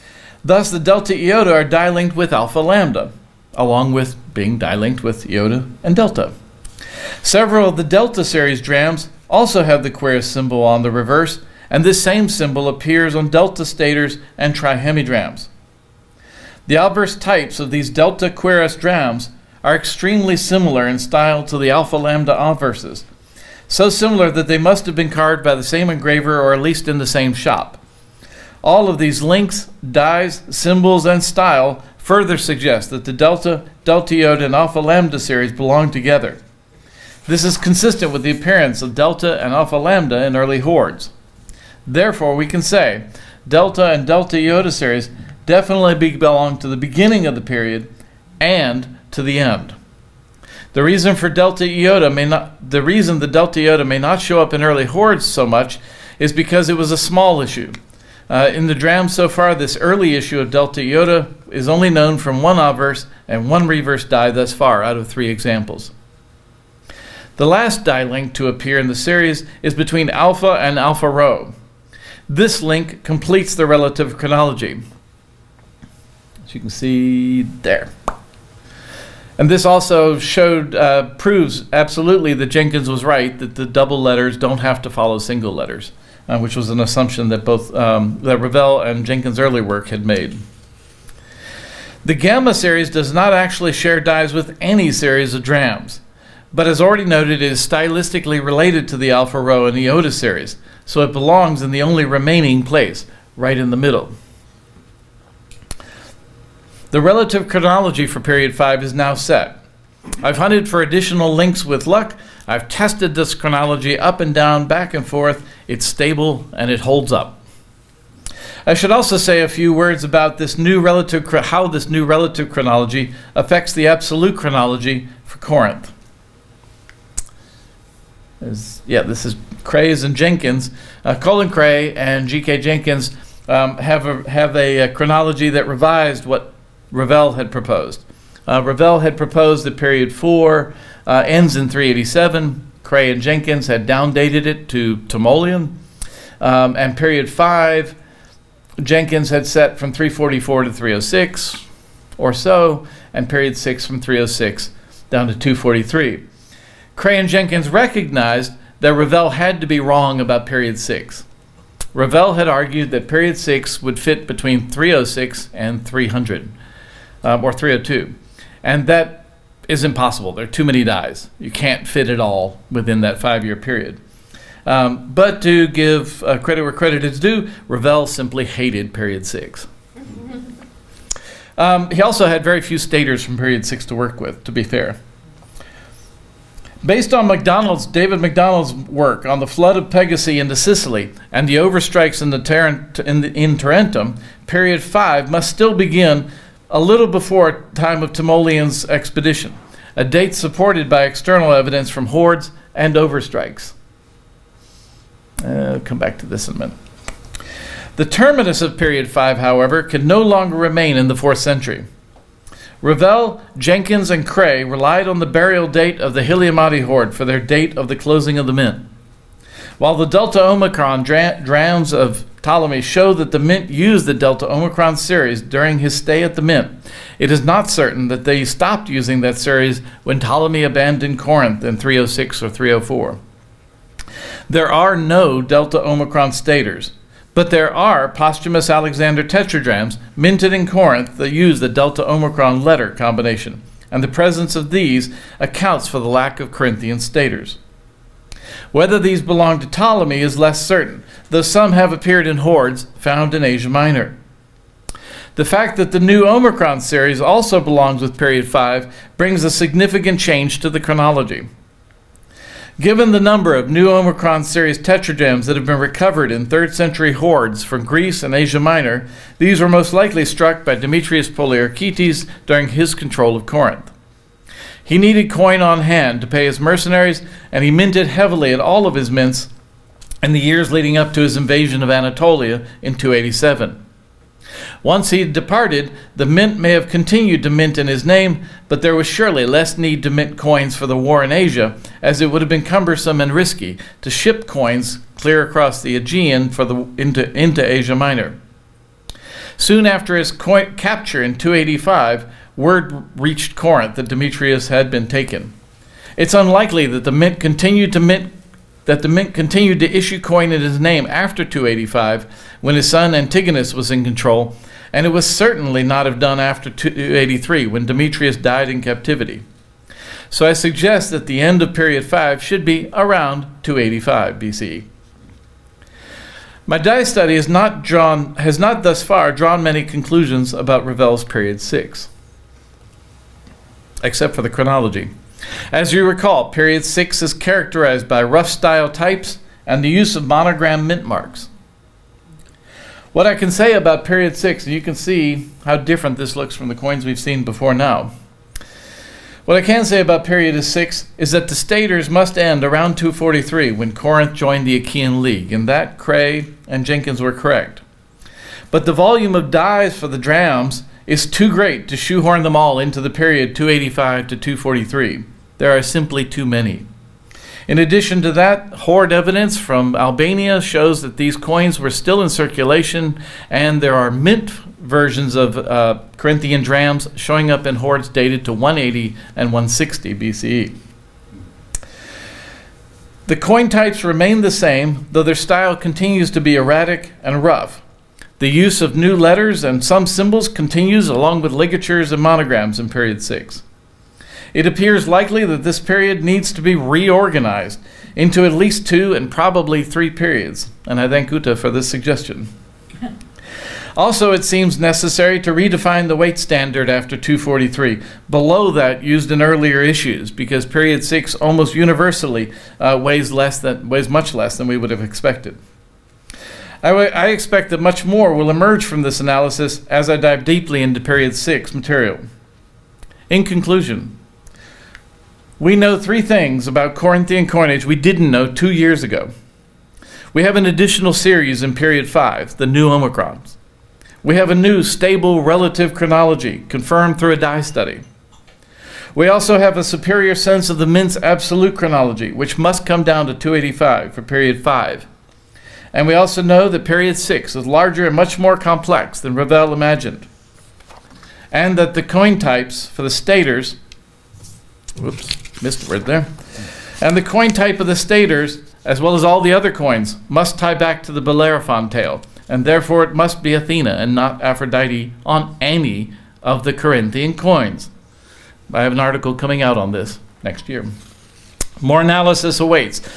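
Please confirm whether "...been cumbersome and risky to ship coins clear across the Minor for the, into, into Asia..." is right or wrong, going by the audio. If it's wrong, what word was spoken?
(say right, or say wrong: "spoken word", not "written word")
wrong: "Aegean", not "Minor".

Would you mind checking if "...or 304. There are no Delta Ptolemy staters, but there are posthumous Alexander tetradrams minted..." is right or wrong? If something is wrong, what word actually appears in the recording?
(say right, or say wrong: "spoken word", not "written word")
wrong: "Omicron", not "Ptolemy".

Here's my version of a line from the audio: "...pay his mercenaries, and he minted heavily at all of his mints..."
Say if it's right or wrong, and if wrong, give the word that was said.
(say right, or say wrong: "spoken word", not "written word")
right.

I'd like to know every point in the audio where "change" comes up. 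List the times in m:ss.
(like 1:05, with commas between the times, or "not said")
4:20.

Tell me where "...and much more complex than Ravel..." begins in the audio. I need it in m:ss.
7:28.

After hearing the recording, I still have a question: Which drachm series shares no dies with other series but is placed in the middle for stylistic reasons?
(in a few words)
gamma.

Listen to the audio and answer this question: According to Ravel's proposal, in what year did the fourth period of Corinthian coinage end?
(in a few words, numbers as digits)
387.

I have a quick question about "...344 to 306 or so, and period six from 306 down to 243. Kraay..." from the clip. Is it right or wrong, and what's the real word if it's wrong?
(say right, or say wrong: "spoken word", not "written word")
right.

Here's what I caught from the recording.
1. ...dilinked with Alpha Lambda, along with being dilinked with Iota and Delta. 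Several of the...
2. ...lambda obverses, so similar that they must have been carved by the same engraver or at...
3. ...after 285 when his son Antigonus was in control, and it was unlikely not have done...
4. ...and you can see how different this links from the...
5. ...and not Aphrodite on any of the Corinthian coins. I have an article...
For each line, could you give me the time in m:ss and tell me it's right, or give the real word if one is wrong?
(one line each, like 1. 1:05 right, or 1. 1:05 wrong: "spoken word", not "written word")
1. 0:01 right
2. 0:21 right
3. 5:11 wrong: "certainly", not "unlikely"
4. 5:44 wrong: "looks", not "links"
5. 7:43 right.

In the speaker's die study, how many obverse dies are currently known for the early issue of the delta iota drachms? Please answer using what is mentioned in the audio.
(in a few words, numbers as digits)
1.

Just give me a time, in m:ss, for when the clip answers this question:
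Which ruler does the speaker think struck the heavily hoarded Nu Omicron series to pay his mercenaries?
4:30.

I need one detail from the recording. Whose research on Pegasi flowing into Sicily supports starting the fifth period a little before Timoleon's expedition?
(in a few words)
David MacDonald.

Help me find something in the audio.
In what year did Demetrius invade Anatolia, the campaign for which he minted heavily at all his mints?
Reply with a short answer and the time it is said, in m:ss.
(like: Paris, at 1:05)
287, at 4:42.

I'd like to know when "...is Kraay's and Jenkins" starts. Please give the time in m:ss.
2:09.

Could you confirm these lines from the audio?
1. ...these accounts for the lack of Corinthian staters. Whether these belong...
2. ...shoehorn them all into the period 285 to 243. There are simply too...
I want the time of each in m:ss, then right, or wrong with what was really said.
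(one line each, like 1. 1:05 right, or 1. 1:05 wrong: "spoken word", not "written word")
1. 4:04 right
2. 6:01 right.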